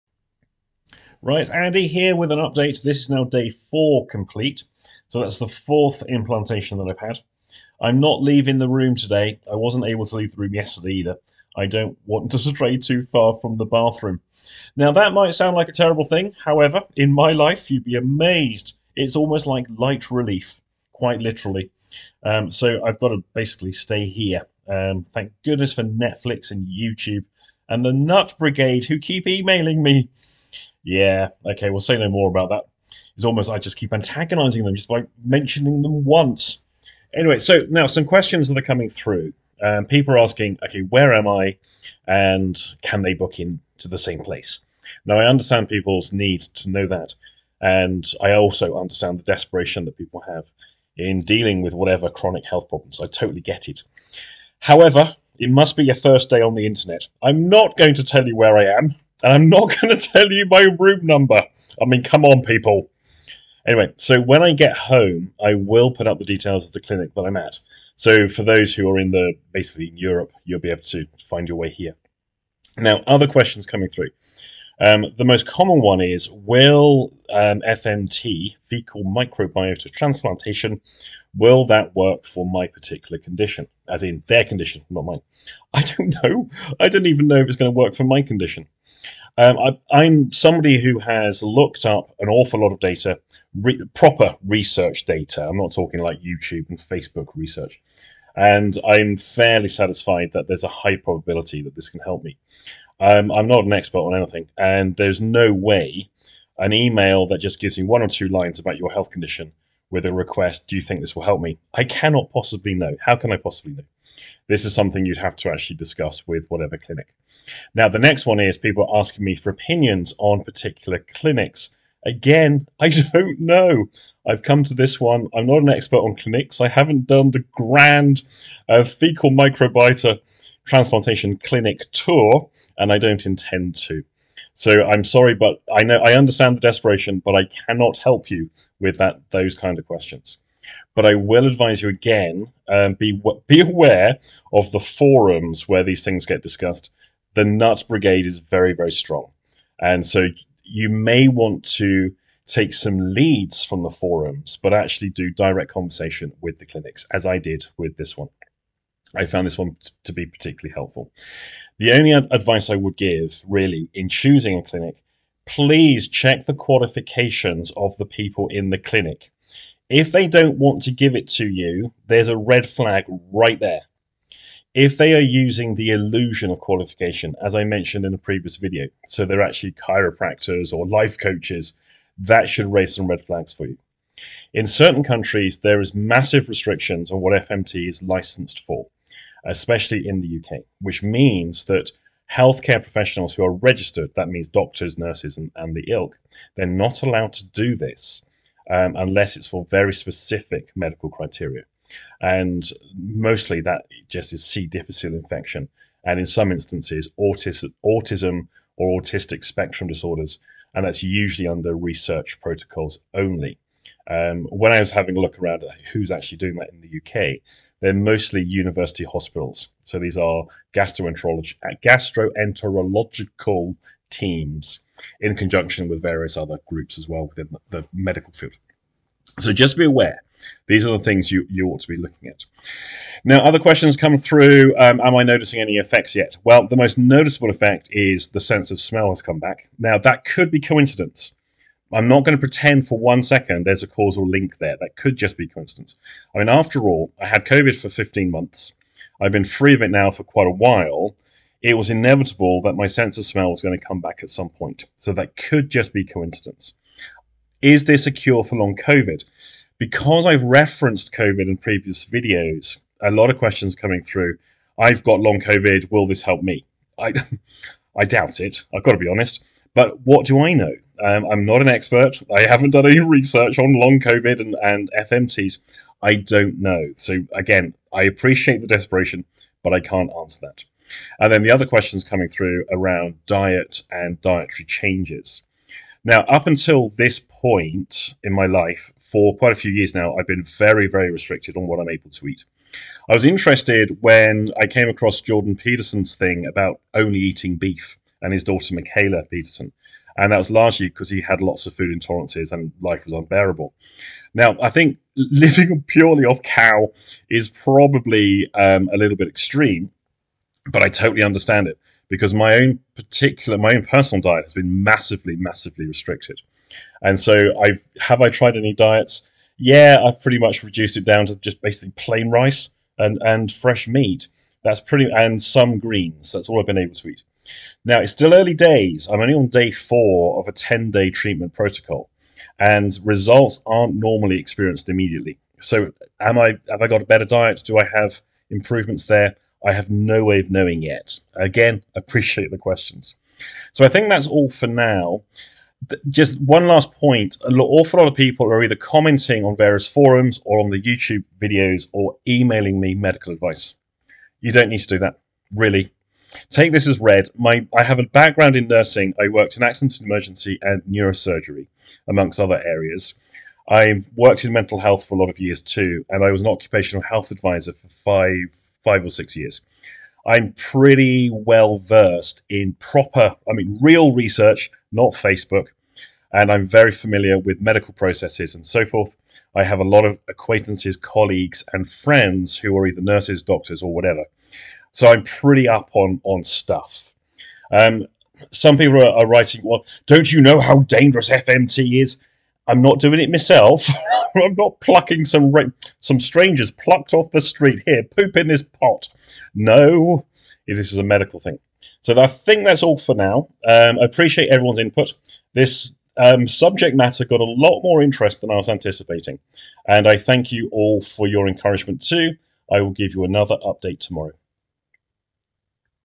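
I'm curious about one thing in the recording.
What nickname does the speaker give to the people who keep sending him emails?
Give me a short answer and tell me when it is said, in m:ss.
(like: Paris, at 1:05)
Nut Brigade, at 0:27.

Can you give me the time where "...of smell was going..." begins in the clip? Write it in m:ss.
4:13.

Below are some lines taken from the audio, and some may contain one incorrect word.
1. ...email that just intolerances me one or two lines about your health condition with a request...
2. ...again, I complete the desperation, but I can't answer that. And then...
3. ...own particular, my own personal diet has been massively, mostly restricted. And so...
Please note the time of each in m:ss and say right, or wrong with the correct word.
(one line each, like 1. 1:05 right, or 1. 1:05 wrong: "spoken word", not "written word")
1. 1:46 wrong: "gives", not "intolerances"
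2. 4:37 wrong: "appreciate", not "complete"
3. 5:12 wrong: "massively", not "mostly".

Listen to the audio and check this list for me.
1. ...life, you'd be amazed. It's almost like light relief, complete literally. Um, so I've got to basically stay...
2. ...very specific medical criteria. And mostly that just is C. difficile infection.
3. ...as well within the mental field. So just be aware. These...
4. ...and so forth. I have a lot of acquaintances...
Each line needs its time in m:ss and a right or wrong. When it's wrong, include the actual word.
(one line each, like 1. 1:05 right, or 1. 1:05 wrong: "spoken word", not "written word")
1. 0:17 wrong: "quite", not "complete"
2. 3:19 right
3. 3:46 wrong: "medical", not "mental"
4. 6:18 right.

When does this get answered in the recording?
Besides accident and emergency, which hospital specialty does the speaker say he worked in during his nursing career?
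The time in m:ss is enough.
6:00.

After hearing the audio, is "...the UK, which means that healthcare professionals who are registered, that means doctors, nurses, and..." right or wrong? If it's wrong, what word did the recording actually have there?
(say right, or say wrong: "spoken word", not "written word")
right.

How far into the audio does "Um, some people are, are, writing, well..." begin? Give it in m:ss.
6:27.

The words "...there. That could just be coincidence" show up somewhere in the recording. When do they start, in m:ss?
4:04.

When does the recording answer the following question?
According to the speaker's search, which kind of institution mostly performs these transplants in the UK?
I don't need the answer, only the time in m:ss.
3:38.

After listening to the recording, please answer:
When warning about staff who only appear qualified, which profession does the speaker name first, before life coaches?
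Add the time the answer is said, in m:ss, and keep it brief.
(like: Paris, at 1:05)
Chiropractors, at 2:59.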